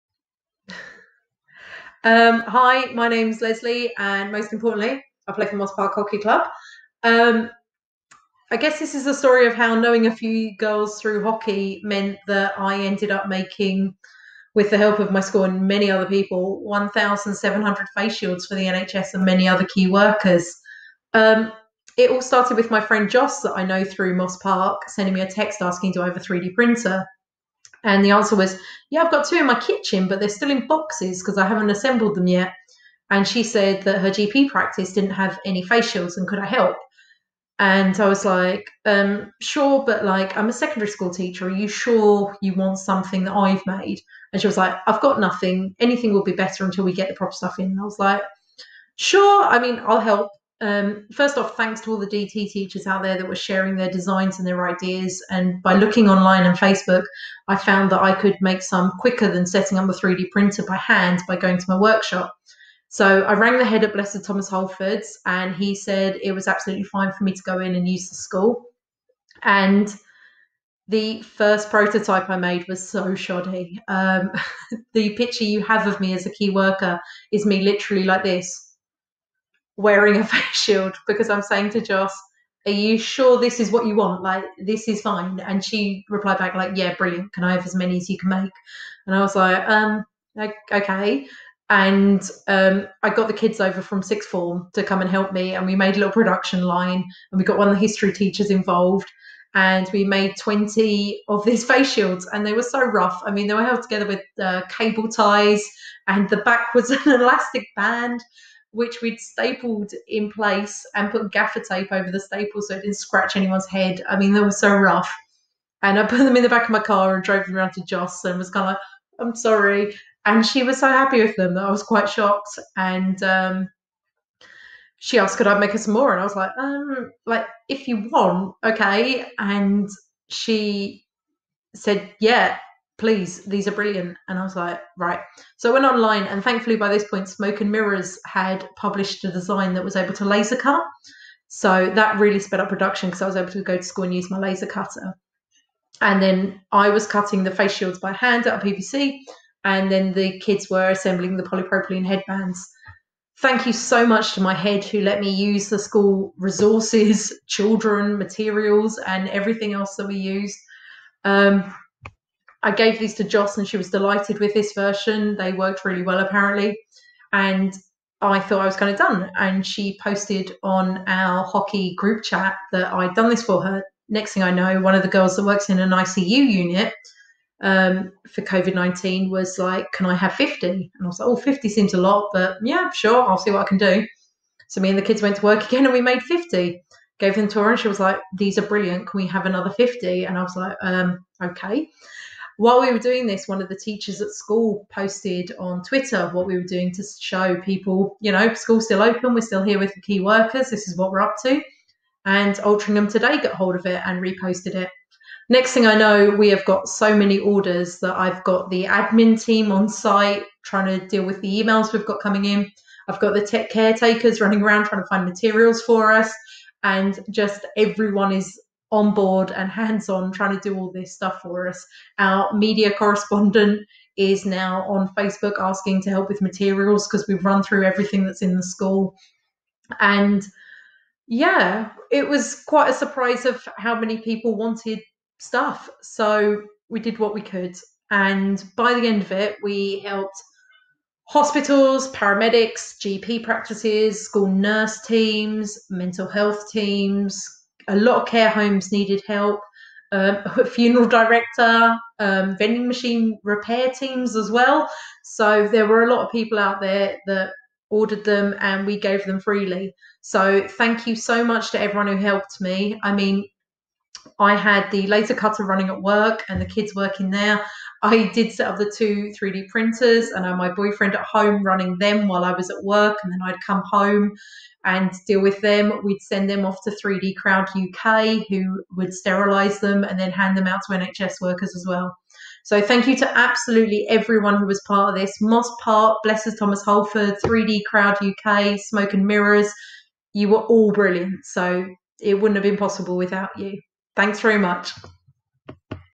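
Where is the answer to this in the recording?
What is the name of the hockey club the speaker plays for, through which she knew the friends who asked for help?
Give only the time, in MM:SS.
00:05.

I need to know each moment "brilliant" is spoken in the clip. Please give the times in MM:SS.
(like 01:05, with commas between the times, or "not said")
01:26, 02:13, 03:08, 04:50.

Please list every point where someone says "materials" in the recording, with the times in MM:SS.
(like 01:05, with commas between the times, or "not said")
02:38, 03:35, 03:46.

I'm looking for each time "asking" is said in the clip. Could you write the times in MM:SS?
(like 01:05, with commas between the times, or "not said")
00:25, 03:45.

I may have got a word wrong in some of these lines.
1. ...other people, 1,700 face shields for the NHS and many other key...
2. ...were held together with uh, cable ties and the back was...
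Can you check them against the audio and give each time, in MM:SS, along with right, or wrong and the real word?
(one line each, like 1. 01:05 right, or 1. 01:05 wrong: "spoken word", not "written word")
1. 00:15 right
2. 01:43 right.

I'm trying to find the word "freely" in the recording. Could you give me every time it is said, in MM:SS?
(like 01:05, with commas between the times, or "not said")
04:19.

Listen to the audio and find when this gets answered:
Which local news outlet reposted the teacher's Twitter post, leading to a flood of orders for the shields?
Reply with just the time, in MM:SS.
03:22.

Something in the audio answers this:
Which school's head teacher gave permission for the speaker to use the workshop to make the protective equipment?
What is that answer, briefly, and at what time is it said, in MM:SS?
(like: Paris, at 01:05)
Blessed Thomas Holford's, at 01:03.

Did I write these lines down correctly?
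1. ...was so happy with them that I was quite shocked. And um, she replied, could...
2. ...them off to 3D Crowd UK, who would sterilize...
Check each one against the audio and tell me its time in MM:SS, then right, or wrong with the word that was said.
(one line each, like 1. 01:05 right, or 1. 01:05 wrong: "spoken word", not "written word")
1. 02:00 wrong: "asked", not "replied"
2. 04:36 right.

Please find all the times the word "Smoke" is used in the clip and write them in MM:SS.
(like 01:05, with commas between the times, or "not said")
02:17, 04:48.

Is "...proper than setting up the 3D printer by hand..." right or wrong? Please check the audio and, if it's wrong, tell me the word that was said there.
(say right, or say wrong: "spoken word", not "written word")
wrong: "quicker", not "proper".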